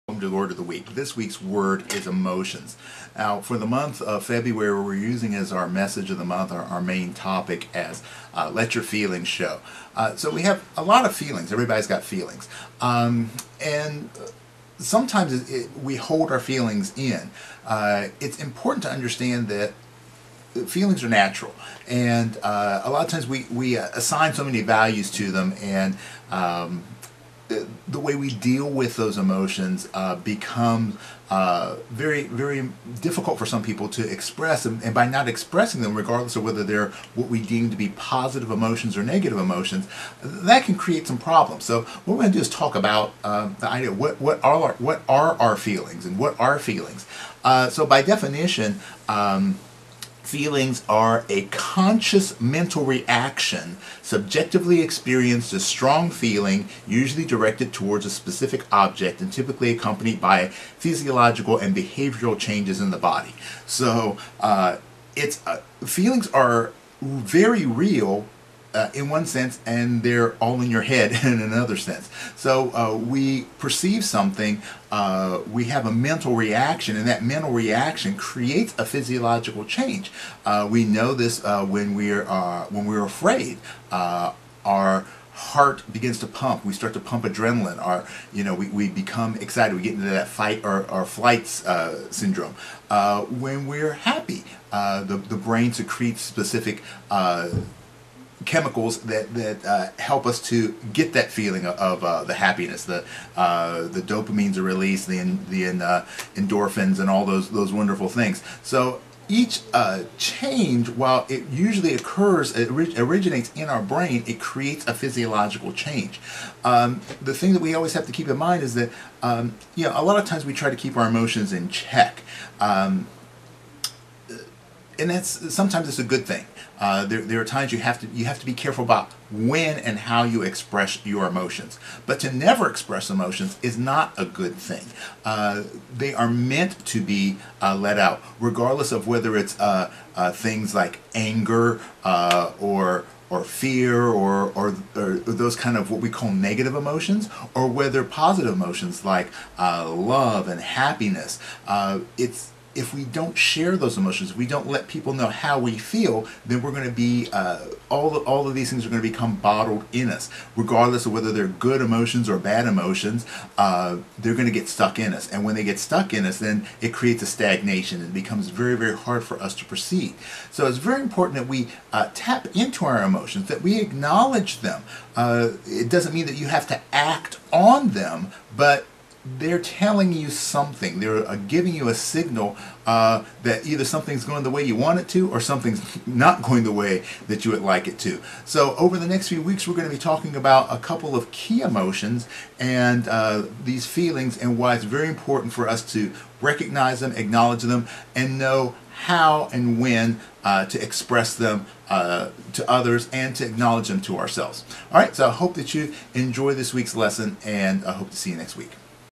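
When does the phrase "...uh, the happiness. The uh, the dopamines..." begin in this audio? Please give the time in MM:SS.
01:42.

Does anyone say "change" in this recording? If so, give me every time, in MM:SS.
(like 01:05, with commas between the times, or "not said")
01:02, 01:19, 01:50, 01:55.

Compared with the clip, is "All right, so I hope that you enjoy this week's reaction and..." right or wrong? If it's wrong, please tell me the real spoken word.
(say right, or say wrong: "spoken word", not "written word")
wrong: "lesson", not "reaction".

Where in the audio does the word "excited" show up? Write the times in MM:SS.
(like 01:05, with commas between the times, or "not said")
01:29.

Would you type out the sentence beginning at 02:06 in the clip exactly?
Uh, there, there are times you have to you have to be careful about when and how you express your emotions.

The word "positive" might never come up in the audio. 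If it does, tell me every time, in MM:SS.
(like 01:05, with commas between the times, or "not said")
00:37, 02:28.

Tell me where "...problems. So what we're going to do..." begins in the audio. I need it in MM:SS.
00:41.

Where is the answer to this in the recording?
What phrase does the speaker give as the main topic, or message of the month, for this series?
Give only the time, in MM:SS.
00:08.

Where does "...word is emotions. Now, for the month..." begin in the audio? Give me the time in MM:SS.
00:01.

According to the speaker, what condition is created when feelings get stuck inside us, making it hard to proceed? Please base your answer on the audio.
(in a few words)
Stagnation.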